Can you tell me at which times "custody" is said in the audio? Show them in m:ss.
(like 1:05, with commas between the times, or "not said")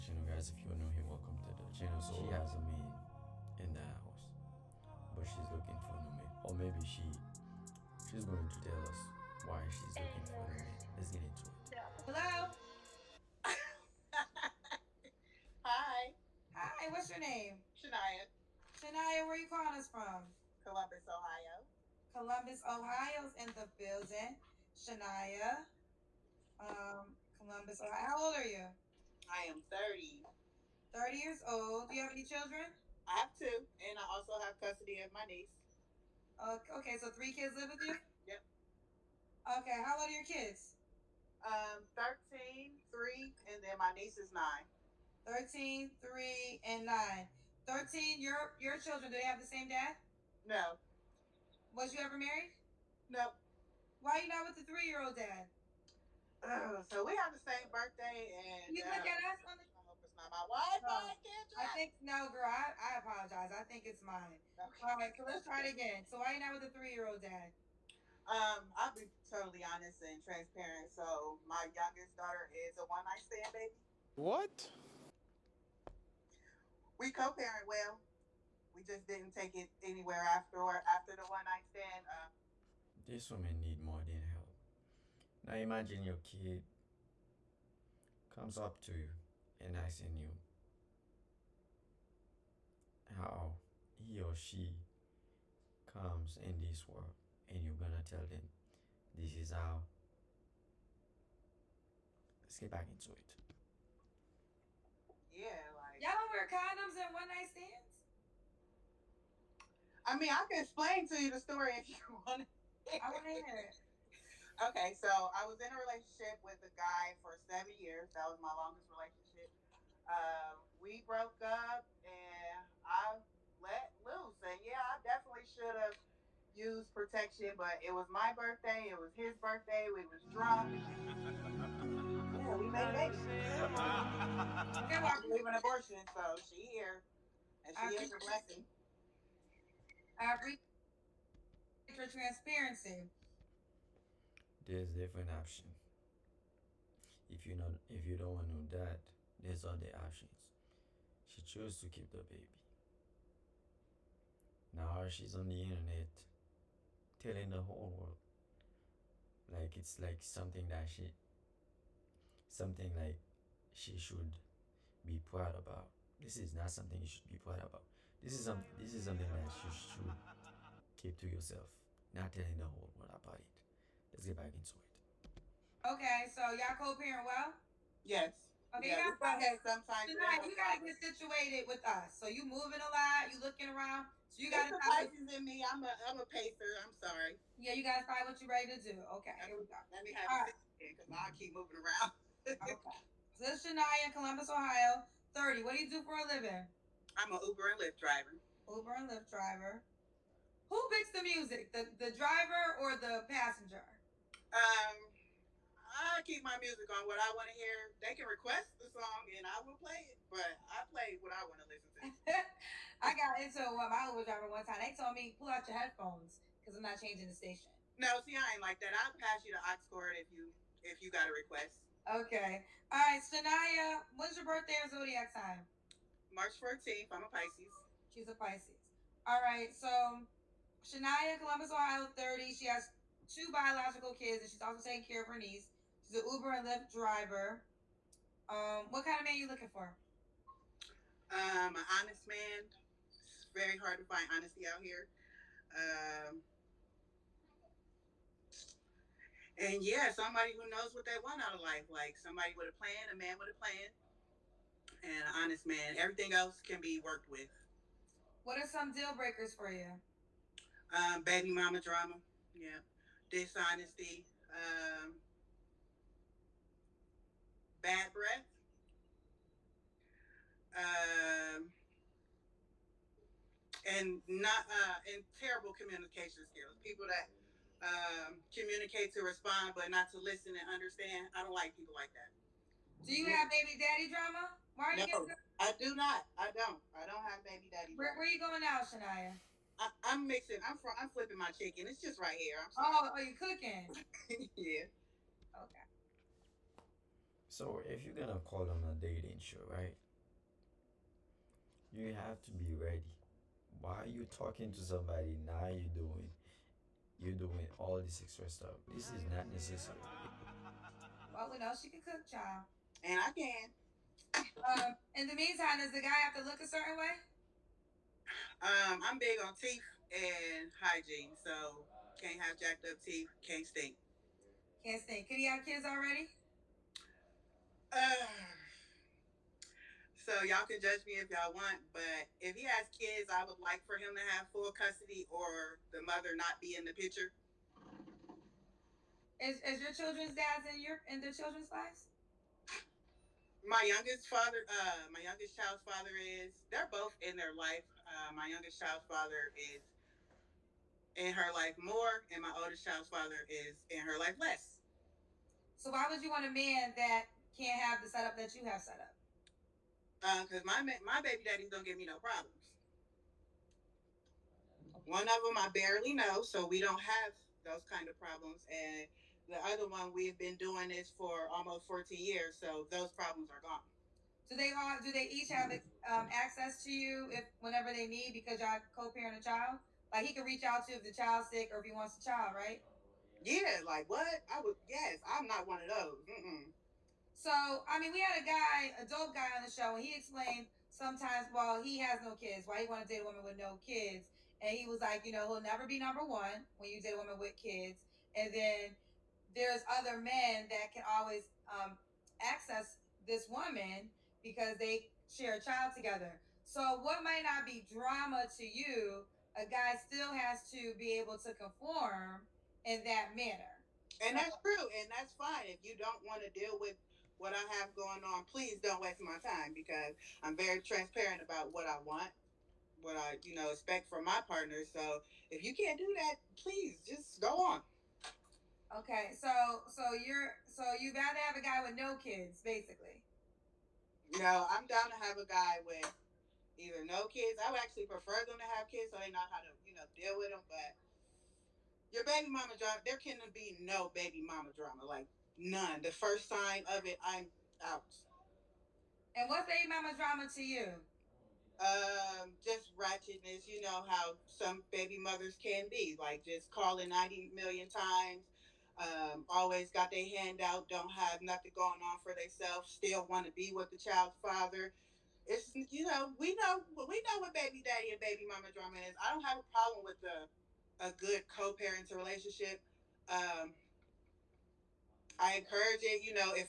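0:34, 5:34.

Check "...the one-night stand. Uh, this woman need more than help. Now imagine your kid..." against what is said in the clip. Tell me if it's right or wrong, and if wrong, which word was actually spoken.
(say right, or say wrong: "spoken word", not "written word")
right.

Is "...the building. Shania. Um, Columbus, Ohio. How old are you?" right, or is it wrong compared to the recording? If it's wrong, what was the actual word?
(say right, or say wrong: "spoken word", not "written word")
right.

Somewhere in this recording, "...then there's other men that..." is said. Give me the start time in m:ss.
6:38.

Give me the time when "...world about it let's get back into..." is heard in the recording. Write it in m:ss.
2:52.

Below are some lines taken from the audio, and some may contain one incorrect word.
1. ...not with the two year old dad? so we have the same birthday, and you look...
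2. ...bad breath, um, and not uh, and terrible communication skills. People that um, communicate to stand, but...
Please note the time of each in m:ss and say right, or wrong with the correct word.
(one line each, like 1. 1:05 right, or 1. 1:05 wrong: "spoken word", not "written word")
1. 0:54 wrong: "three", not "two"
2. 4:27 wrong: "respond", not "stand".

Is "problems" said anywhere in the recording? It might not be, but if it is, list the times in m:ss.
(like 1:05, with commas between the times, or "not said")
6:02, 6:08, 6:13, 7:49.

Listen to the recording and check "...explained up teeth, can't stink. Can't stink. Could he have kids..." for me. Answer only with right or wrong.
wrong.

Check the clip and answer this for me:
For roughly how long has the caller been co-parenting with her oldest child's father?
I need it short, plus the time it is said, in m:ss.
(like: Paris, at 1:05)
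almost 14 years, at 6:11.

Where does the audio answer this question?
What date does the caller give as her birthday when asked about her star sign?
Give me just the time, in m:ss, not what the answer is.
3:46.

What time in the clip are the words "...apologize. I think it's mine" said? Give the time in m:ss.
1:02.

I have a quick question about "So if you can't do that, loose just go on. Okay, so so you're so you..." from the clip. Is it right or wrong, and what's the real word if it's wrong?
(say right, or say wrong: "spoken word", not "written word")
wrong: "please", not "loose".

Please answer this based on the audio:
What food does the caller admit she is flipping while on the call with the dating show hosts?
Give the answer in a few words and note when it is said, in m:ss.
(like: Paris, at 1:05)
chicken, at 4:51.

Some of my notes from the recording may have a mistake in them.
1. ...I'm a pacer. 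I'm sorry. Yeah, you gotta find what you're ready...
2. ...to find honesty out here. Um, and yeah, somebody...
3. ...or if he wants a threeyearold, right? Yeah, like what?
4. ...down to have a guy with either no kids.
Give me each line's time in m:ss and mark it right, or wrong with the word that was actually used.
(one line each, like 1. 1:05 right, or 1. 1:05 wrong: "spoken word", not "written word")
1. 3:06 right
2. 4:03 right
3. 6:21 wrong: "child", not "threeyearold"
4. 7:14 right.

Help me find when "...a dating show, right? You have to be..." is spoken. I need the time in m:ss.
4:58.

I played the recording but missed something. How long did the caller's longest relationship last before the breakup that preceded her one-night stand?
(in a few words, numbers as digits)
7 years.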